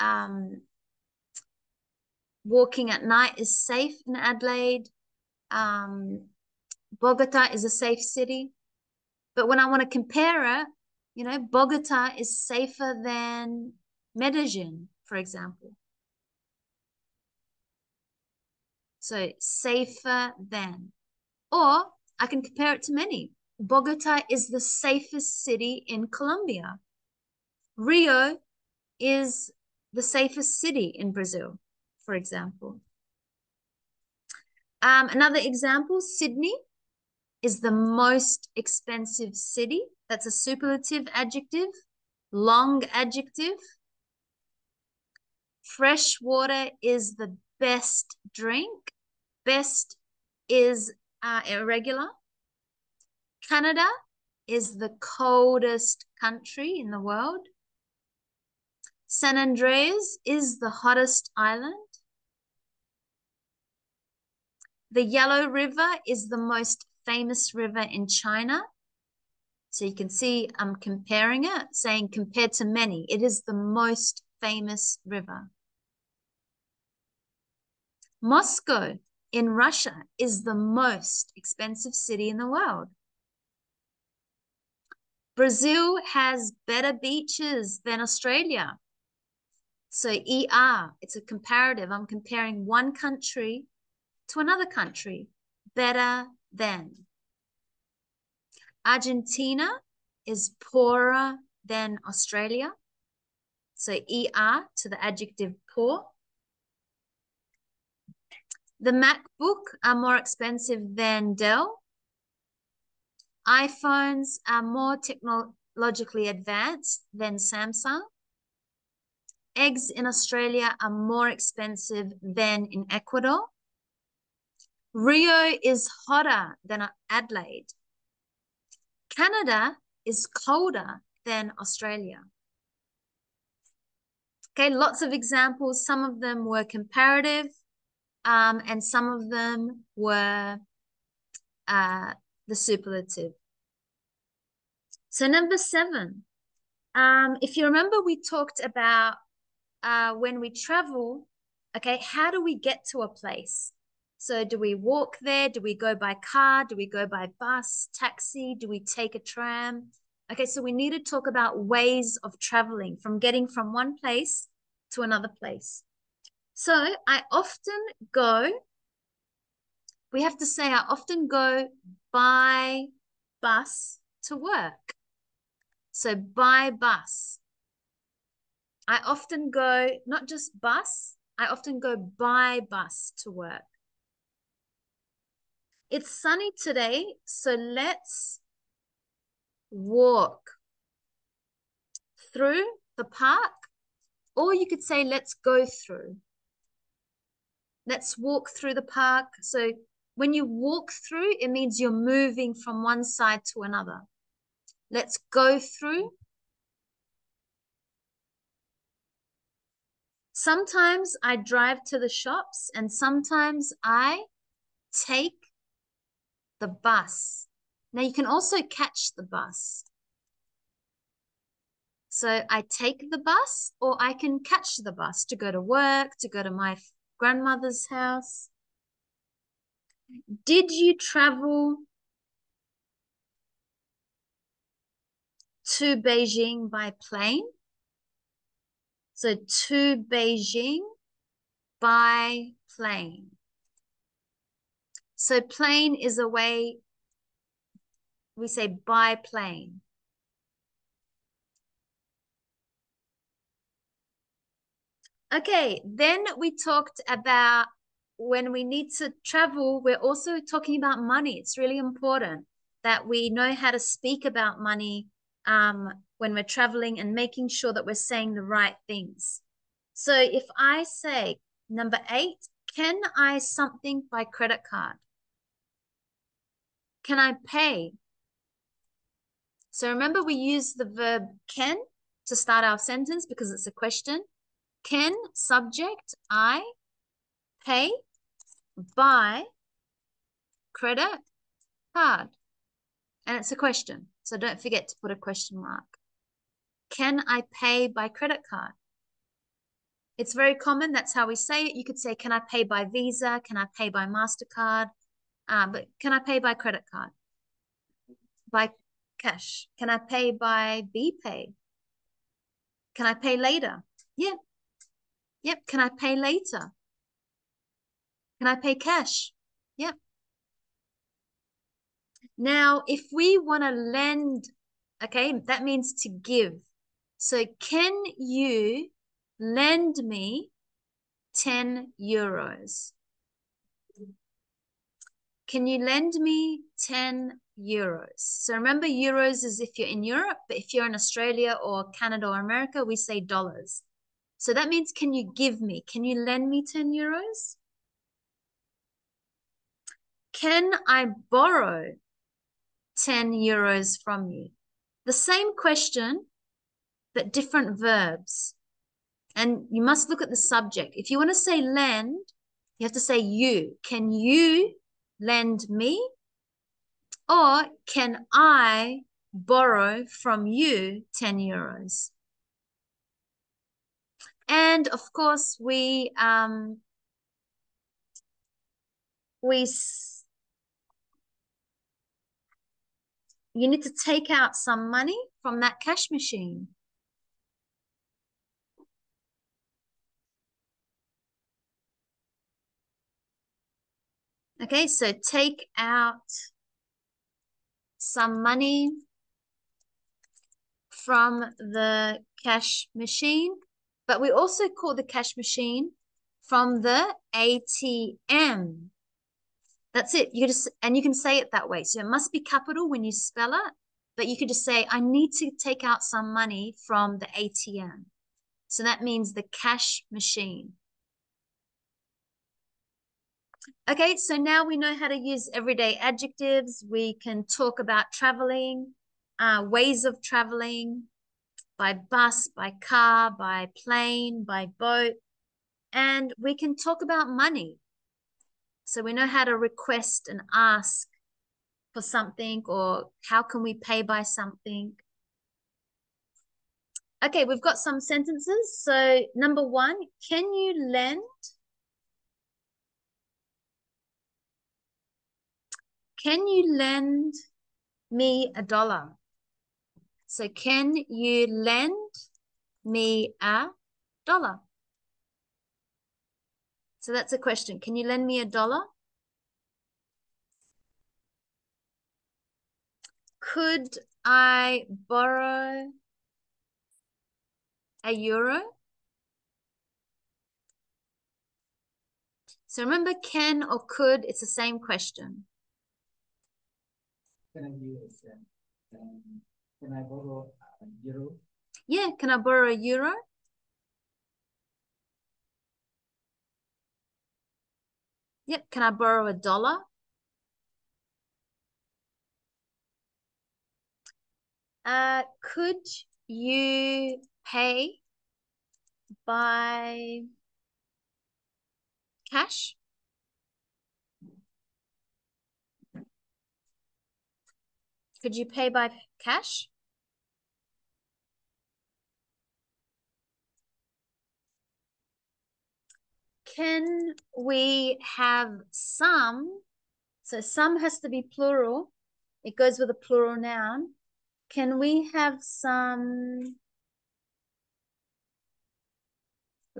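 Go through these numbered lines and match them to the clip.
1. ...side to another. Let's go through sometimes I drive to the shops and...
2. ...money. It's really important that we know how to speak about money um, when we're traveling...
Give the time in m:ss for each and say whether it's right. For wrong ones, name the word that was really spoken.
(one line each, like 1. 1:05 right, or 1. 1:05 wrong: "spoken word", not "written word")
1. 3:23 right
2. 4:20 right.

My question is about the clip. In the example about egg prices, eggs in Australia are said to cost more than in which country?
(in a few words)
Ecuador.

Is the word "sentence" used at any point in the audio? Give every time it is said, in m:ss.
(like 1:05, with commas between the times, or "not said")
4:42, 7:27.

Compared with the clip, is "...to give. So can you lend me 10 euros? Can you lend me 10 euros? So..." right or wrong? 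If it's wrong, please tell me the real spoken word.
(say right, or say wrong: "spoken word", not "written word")
right.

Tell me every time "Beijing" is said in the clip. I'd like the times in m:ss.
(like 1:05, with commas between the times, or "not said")
3:55, 3:59.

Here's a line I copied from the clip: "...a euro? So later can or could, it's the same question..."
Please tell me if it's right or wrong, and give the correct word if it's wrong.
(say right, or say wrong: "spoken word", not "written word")
wrong: "remember", not "later".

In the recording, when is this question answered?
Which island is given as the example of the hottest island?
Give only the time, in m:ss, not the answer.
0:59.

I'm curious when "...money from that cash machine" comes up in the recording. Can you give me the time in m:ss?
6:24.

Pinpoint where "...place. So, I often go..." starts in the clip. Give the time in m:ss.
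2:45.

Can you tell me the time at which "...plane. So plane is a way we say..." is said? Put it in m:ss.
4:02.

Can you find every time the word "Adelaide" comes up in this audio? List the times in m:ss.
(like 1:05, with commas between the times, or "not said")
0:04, 2:07.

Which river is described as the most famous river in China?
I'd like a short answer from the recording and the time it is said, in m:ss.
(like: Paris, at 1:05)
The Yellow River, at 1:04.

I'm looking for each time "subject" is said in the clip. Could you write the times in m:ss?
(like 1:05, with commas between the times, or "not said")
4:45, 6:00.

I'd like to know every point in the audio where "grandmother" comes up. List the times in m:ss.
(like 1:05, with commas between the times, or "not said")
3:47.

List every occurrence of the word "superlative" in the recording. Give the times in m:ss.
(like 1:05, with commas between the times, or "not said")
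0:40, 2:22.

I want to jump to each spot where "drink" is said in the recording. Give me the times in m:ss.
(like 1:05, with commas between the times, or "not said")
0:48.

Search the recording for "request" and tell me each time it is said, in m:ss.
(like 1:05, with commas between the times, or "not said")
7:19.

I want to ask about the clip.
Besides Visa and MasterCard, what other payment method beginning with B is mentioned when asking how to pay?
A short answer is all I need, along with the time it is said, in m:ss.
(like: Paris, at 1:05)
BPay, at 5:10.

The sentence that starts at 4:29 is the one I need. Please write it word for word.
So if I say, number eight, can I something by credit card?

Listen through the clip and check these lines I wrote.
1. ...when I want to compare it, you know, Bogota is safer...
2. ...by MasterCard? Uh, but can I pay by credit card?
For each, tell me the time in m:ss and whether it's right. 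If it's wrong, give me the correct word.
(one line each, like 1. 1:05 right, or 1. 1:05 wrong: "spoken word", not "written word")
1. 0:09 right
2. 5:03 right.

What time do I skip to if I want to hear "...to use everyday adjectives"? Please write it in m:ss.
7:05.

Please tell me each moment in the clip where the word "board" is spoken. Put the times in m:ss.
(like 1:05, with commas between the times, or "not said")
not said.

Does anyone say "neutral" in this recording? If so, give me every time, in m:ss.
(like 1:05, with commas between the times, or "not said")
not said.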